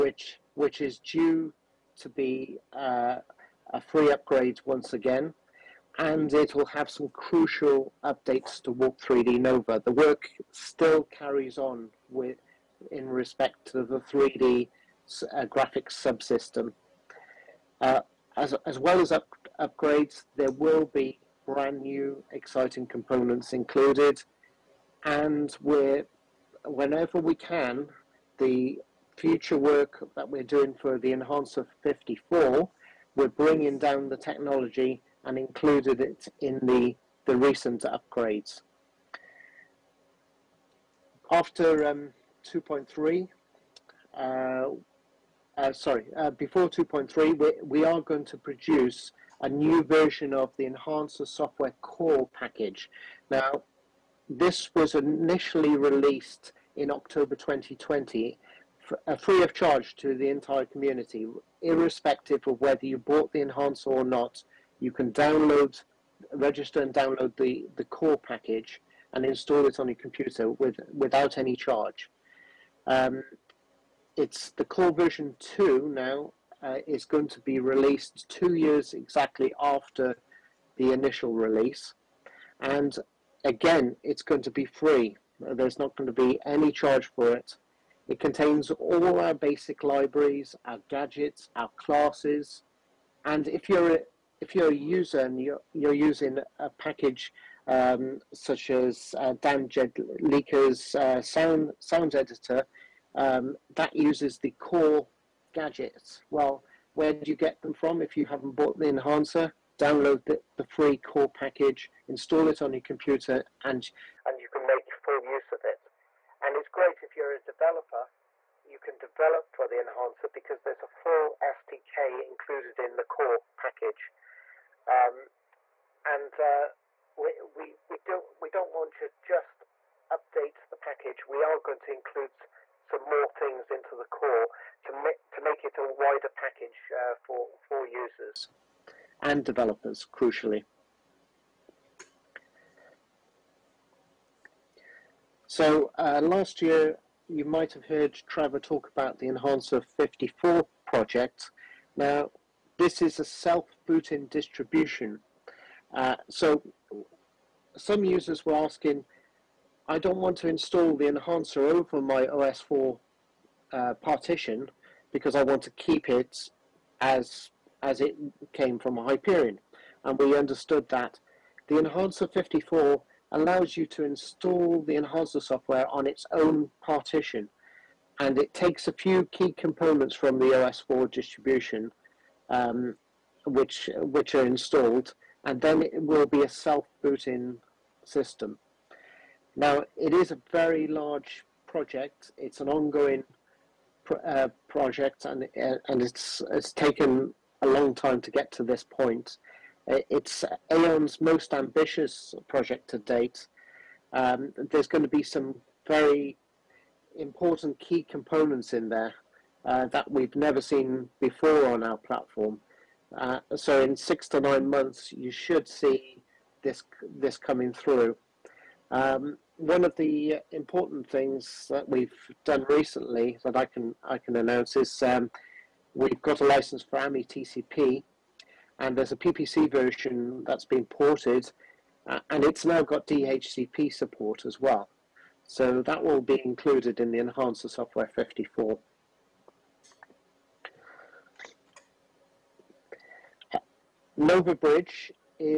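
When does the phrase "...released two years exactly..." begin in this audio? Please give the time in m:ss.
1:17.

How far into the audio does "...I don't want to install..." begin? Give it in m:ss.
2:39.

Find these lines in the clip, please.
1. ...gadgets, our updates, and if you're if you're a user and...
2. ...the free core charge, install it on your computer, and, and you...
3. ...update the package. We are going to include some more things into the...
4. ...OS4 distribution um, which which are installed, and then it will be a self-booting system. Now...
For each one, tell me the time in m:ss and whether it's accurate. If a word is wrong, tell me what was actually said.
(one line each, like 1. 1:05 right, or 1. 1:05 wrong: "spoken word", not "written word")
1. 1:30 wrong: "classes", not "updates"
2. 1:50 wrong: "package", not "charge"
3. 2:10 right
4. 3:00 right.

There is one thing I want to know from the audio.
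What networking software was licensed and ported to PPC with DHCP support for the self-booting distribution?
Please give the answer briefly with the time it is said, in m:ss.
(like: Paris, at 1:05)
AmiTCP, at 3:46.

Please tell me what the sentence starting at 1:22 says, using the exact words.
And again, it's going to be free.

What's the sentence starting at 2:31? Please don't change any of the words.
Now, this is a self-booting distribution.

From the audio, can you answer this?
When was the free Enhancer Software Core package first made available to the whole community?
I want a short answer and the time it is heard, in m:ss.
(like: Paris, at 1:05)
October 2020, at 0:56.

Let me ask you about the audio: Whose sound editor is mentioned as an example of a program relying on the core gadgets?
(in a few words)
Dan Jedlicka.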